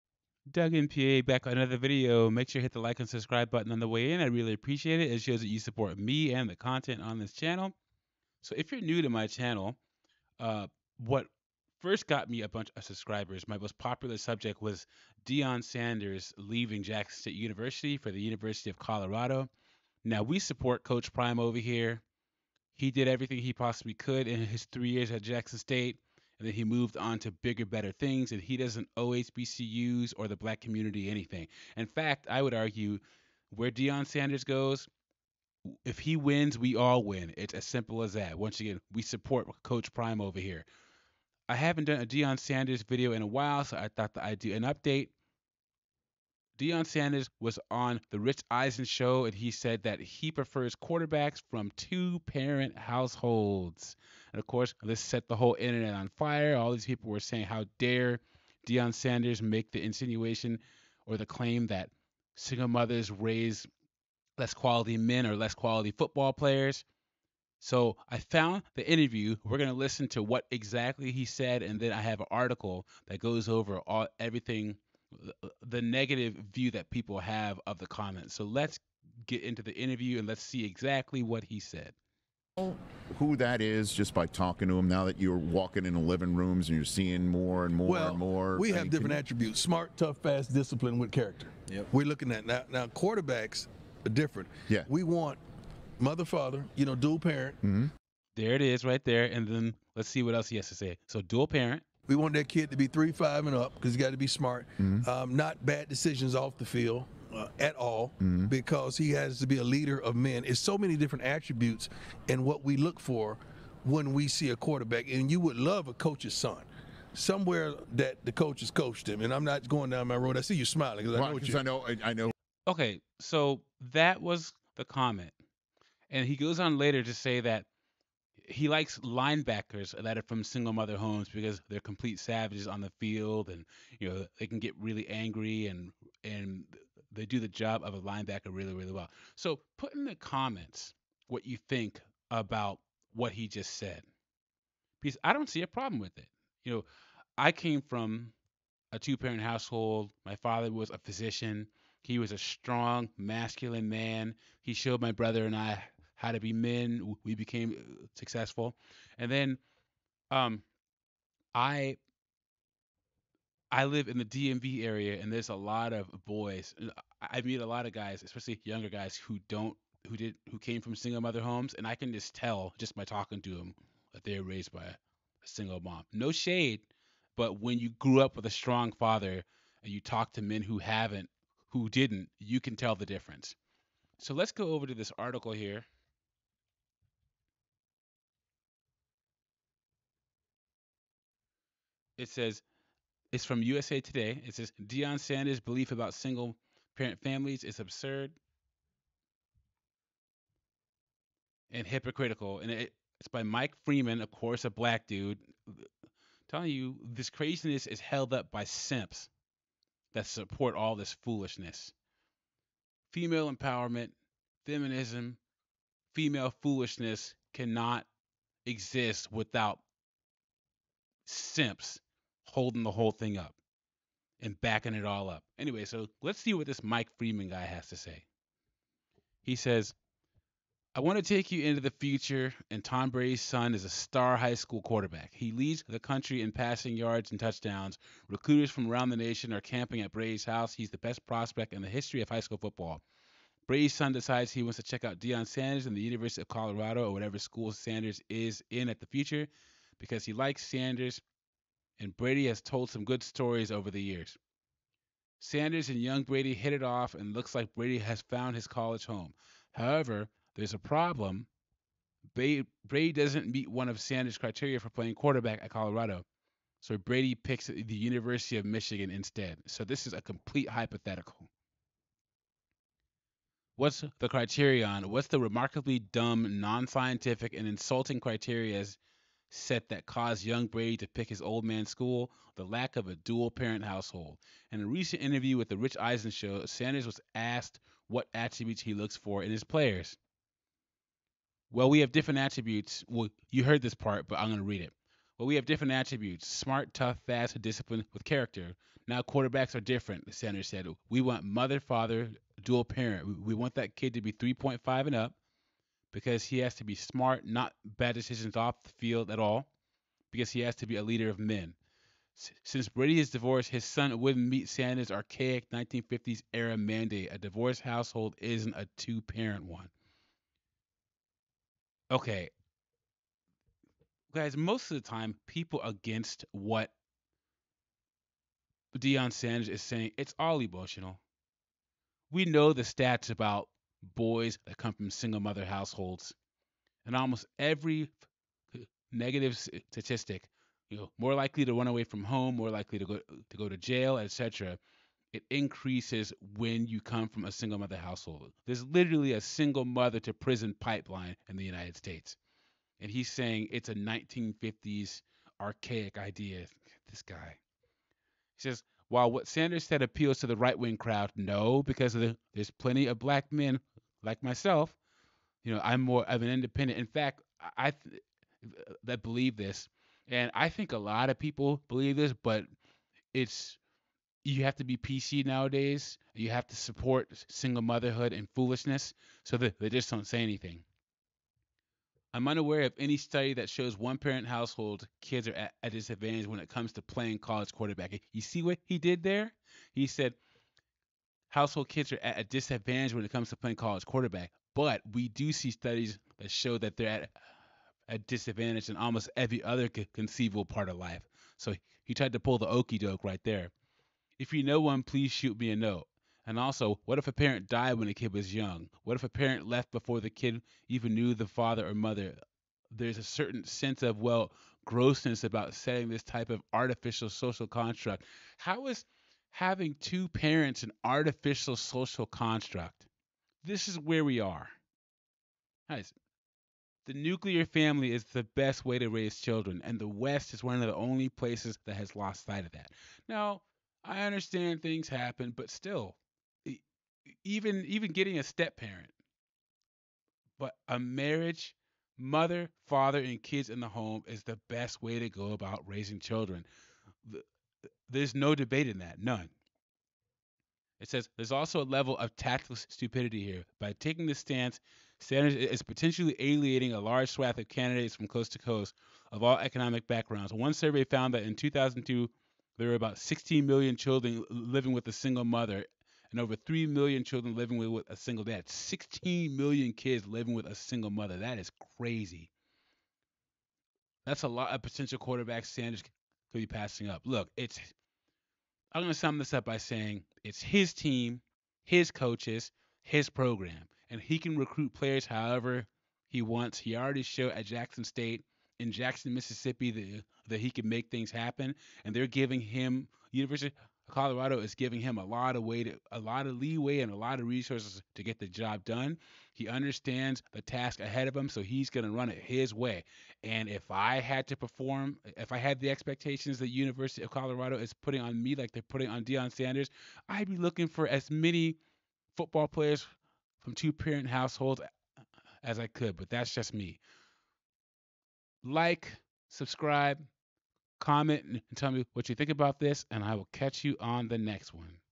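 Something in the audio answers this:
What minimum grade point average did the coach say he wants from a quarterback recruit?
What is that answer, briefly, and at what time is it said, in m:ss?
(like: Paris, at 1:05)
3.5, at 1:42.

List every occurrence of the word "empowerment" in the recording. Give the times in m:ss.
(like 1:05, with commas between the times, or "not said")
3:33.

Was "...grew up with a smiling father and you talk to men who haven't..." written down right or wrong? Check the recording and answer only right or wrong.
wrong.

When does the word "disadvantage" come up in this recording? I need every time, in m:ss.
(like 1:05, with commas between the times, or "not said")
6:25, 6:32, 6:38.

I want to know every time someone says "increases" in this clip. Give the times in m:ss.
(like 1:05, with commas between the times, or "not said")
5:45.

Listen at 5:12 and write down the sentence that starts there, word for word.
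S- since Brady is divorced, his son wouldn't meet Sanders' archaic 1950s era mandate.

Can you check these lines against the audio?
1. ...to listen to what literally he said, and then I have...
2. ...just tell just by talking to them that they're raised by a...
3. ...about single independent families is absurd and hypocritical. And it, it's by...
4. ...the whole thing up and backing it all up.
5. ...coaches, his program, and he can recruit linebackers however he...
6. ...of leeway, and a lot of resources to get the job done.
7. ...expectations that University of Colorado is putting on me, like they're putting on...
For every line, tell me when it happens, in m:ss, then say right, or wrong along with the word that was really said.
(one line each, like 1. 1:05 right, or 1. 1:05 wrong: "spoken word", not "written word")
1. 1:09 wrong: "exactly", not "literally"
2. 2:52 right
3. 3:15 wrong: "parent", not "independent"
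4. 3:42 right
5. 8:02 wrong: "players", not "linebackers"
6. 8:16 right
7. 8:25 right.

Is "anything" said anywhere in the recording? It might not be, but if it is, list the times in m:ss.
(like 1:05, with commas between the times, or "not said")
0:31, 6:20.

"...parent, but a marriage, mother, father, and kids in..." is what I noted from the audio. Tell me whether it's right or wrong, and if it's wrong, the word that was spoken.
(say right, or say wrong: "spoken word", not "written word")
right.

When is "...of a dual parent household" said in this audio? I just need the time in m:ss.
4:42.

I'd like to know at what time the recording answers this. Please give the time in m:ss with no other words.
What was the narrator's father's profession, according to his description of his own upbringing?
2:30.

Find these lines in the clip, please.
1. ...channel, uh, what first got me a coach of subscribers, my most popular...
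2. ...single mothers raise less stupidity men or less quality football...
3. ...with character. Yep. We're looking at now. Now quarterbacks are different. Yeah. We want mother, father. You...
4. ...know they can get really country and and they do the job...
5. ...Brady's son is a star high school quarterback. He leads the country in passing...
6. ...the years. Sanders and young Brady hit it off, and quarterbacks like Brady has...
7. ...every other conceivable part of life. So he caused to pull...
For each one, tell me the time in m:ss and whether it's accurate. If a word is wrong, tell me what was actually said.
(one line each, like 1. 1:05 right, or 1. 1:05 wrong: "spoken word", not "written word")
1. 0:09 wrong: "bunch", not "coach"
2. 1:02 wrong: "quality", not "stupidity"
3. 1:30 right
4. 2:14 wrong: "angry", not "country"
5. 3:53 right
6. 4:13 wrong: "looks", not "quarterbacks"
7. 6:39 wrong: "tried", not "caused".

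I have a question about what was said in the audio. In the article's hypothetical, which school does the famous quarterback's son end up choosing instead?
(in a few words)
University of Michigan.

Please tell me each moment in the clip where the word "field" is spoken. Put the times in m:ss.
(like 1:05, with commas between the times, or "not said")
1:46, 2:12, 5:08.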